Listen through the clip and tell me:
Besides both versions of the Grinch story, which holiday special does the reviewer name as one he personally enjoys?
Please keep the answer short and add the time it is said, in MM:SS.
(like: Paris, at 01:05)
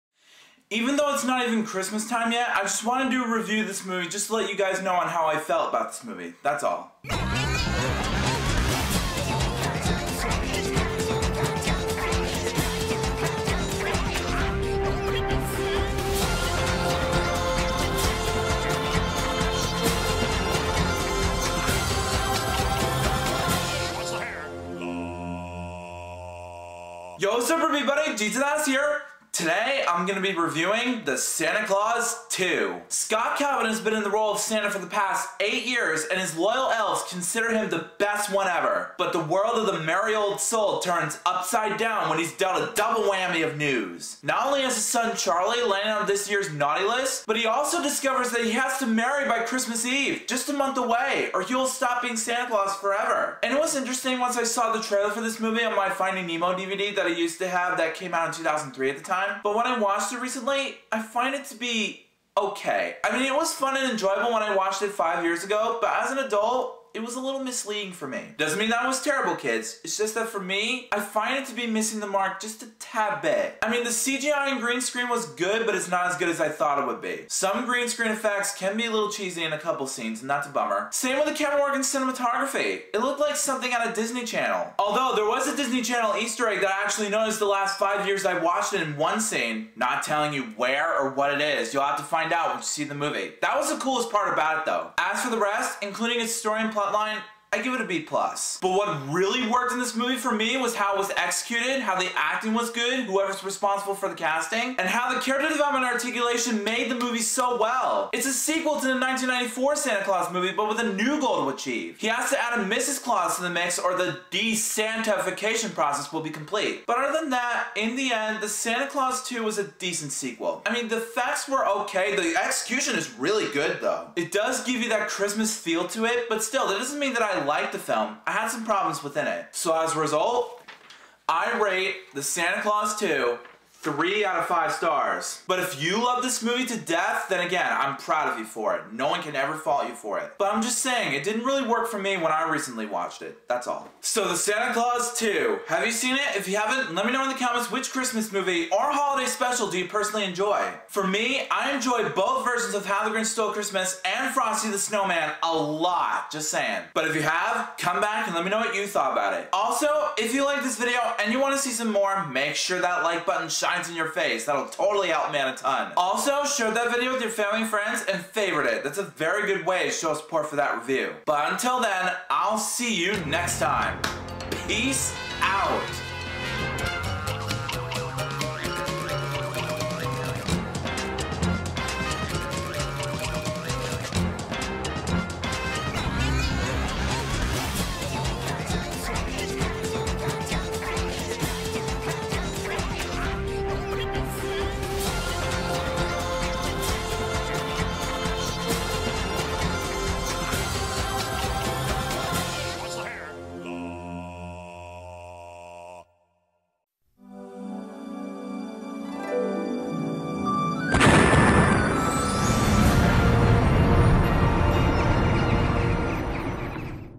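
Frosty the Snowman, at 02:34.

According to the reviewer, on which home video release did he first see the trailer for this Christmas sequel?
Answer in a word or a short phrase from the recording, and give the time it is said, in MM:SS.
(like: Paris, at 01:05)
Finding Nemo DVD, at 00:55.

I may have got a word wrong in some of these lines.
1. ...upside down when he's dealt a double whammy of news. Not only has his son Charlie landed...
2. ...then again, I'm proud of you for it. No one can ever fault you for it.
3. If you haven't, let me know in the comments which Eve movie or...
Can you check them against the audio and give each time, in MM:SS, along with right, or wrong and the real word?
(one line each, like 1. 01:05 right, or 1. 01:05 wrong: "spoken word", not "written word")
1. 00:41 right
2. 02:17 right
3. 02:26 wrong: "Christmas", not "Eve".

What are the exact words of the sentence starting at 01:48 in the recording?
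It's a sequel to the 1994 Santa Clause movie, but with a new goal to achieve.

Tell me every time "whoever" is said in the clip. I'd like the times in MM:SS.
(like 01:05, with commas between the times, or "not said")
01:43.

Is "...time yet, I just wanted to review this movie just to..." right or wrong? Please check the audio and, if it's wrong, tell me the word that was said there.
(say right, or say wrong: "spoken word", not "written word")
right.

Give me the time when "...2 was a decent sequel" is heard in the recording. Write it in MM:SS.
01:59.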